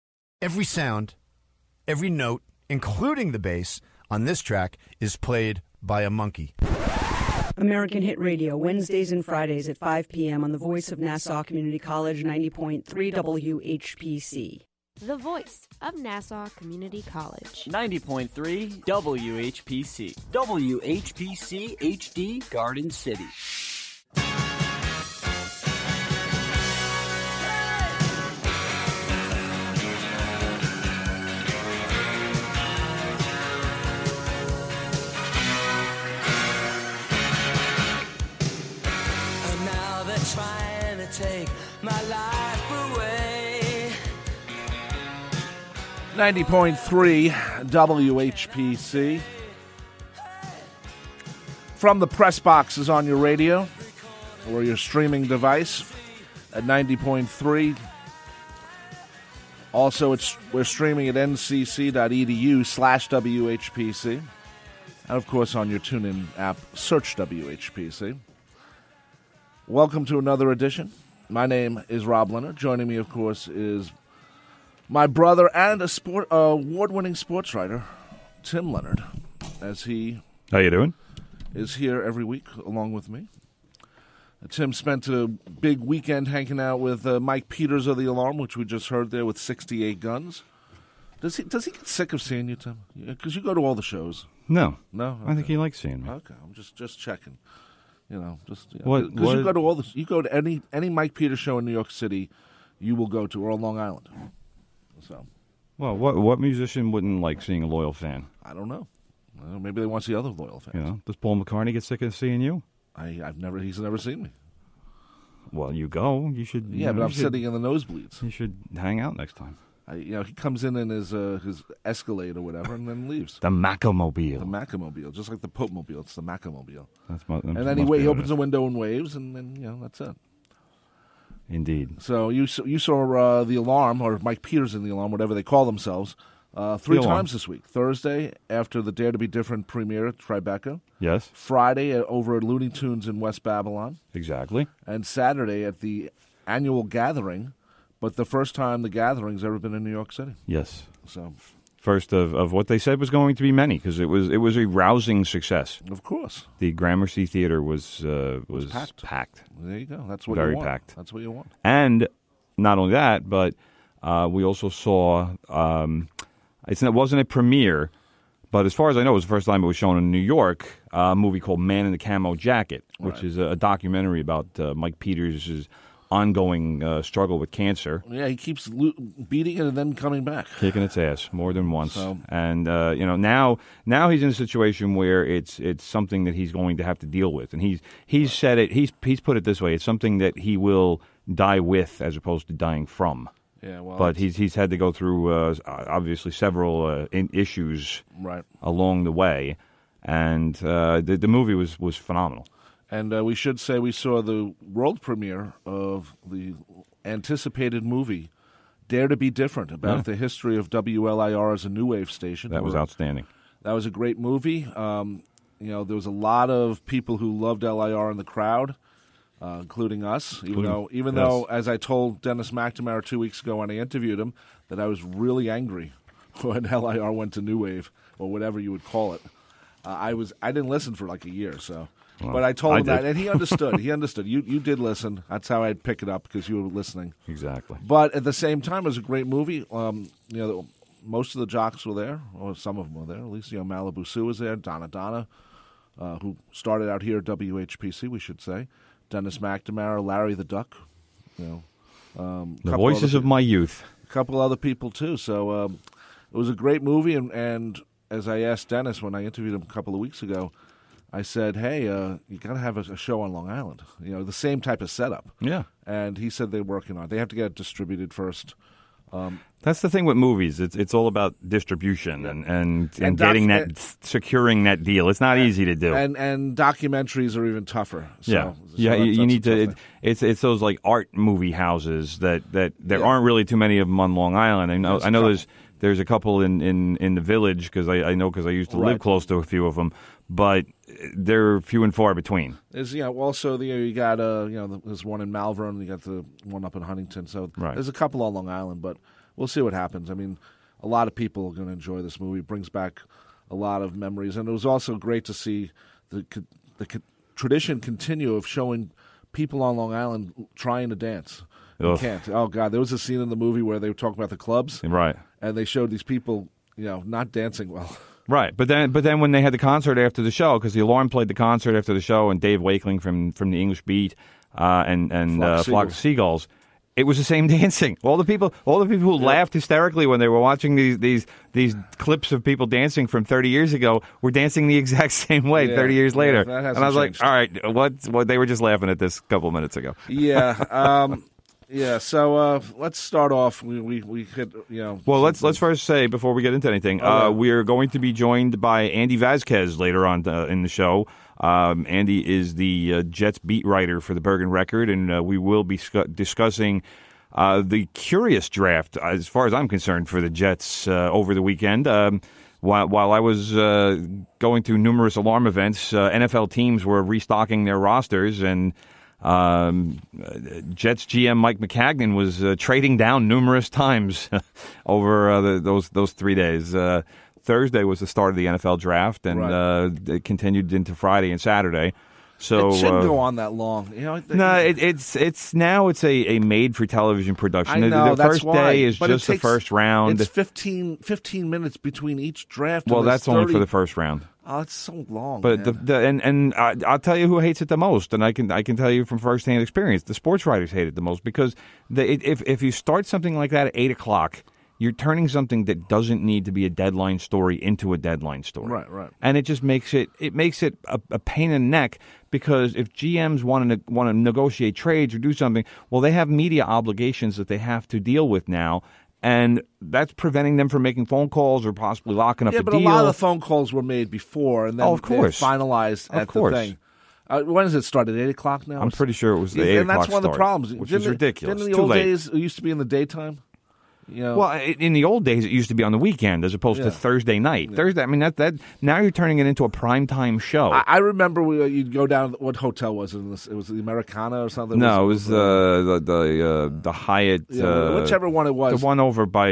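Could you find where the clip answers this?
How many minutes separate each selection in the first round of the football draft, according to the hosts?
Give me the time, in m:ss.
6:30.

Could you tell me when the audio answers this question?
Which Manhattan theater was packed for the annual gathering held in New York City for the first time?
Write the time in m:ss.
2:36.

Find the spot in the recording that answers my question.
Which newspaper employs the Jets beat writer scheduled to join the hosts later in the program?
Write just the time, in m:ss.
5:54.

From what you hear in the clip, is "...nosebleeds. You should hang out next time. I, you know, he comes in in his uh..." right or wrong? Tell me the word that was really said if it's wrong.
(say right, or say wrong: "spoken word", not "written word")
right.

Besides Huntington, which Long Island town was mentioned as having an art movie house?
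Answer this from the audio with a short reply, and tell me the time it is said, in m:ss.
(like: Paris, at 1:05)
Malverne, at 4:55.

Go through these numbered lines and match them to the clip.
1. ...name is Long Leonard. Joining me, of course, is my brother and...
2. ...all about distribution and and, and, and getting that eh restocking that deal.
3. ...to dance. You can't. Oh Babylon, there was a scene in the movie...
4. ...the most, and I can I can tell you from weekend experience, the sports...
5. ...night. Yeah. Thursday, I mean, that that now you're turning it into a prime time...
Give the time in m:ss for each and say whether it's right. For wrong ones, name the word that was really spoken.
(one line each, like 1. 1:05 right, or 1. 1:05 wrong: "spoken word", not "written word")
1. 1:11 wrong: "Rob", not "Long"
2. 4:30 wrong: "securing", not "restocking"
3. 5:10 wrong: "God", not "Babylon"
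4. 6:37 wrong: "firsthand", not "weekend"
5. 7:17 right.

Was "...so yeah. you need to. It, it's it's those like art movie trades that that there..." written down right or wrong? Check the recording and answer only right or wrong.
wrong.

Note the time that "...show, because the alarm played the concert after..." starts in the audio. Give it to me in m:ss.
5:20.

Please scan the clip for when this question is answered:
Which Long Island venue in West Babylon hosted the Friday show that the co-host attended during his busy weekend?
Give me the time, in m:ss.
2:22.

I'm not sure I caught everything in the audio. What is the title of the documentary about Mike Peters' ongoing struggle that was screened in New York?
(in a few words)
Man in the Camo Jacket.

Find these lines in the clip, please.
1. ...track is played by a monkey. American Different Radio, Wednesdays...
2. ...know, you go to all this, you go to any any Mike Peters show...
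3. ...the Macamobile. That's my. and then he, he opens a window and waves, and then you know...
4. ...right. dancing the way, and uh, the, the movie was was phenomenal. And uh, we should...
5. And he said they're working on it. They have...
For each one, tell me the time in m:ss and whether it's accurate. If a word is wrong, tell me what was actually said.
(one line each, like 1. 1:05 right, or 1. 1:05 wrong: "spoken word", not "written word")
1. 0:04 wrong: "Hit", not "Different"
2. 1:39 right
3. 2:06 right
4. 3:18 wrong: "along", not "dancing"
5. 4:25 right.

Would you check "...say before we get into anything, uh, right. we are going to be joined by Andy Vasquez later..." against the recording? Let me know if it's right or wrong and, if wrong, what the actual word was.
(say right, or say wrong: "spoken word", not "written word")
right.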